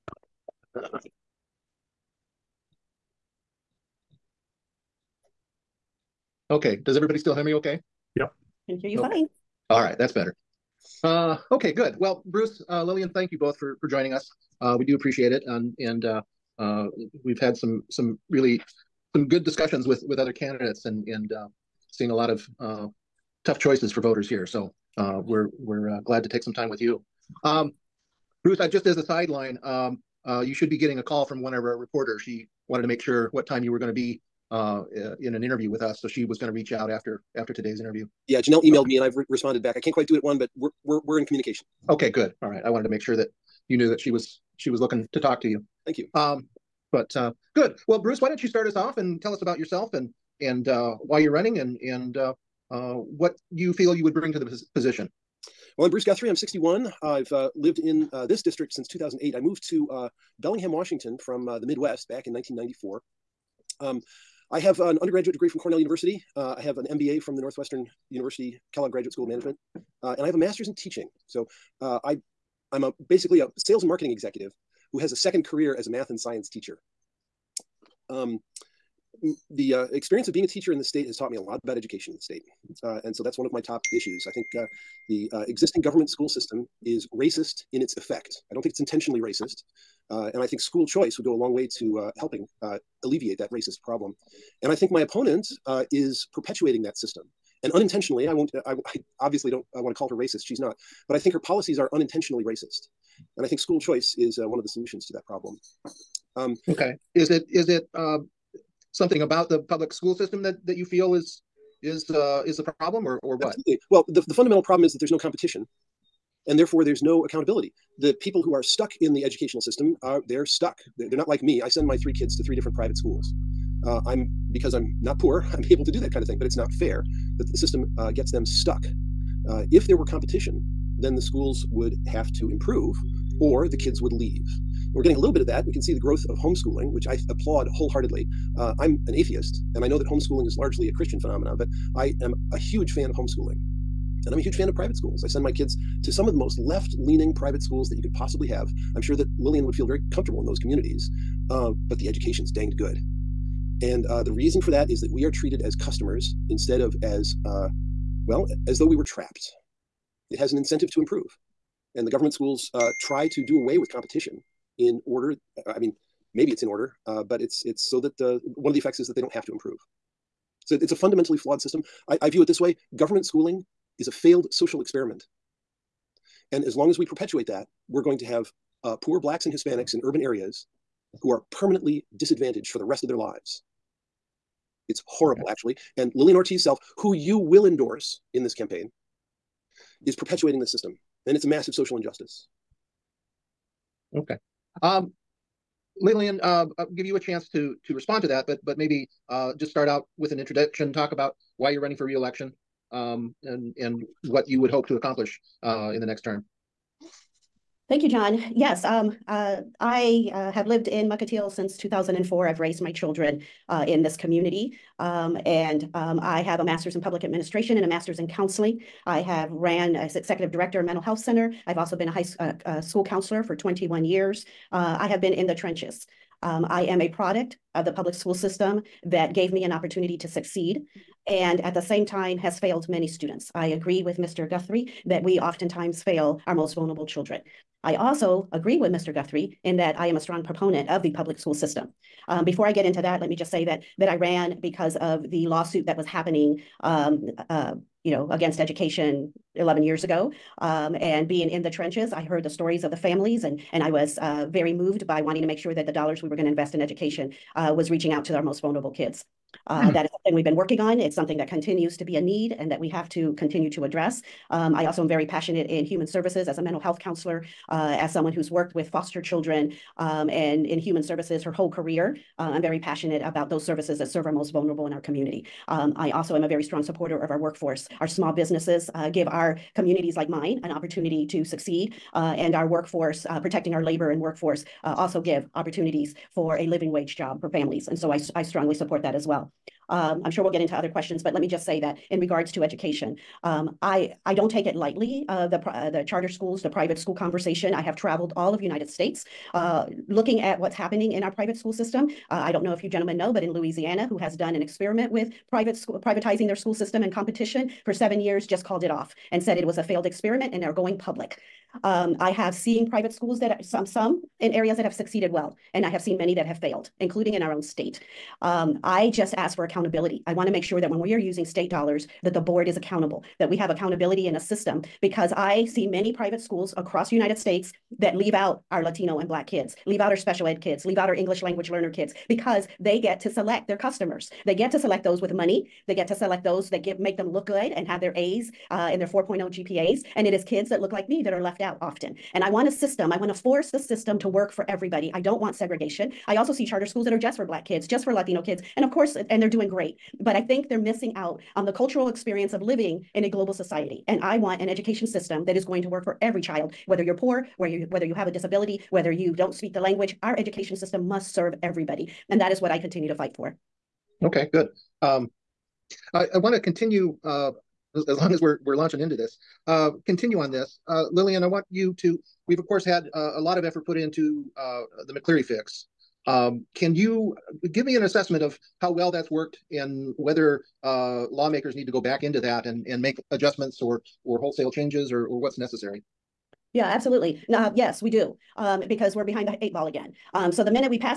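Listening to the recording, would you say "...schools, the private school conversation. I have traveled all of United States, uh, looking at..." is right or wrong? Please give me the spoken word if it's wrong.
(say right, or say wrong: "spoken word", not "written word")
right.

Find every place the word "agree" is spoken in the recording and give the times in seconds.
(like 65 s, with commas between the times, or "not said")
233 s, 238 s.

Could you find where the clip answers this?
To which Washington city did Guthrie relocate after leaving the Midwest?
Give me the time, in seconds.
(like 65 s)
60 s.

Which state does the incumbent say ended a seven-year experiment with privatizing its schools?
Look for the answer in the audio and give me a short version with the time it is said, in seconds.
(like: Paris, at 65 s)
Louisiana, at 303 s.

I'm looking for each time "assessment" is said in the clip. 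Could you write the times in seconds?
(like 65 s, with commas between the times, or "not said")
378 s.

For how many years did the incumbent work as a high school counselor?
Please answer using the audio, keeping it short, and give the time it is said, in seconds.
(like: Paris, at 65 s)
21 years, at 223 s.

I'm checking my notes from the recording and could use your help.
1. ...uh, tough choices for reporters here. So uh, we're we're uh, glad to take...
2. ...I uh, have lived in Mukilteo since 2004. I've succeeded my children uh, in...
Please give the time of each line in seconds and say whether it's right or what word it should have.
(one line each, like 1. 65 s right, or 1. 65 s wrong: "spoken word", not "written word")
1. 22 s wrong: "voters", not "reporters"
2. 209 s wrong: "raised", not "succeeded".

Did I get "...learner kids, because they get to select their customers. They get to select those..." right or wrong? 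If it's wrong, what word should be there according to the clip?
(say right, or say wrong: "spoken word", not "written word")
right.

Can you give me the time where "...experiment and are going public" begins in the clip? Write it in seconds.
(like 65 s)
310 s.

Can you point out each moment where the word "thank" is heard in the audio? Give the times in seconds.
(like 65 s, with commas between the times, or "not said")
13 s, 45 s, 207 s.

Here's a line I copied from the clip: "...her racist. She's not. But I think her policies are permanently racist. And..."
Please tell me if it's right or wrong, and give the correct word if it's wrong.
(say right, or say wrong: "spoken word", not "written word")
wrong: "unintentionally", not "permanently".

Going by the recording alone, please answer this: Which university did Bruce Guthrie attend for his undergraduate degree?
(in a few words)
Cornell University.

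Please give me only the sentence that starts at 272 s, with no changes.
Uh, I'm very passionate about those services that serve our most vulnerable in our community.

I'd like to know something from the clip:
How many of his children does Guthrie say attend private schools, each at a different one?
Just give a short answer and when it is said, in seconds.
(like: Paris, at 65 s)
3, at 121 s.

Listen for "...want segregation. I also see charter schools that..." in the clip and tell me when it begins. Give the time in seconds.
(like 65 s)
345 s.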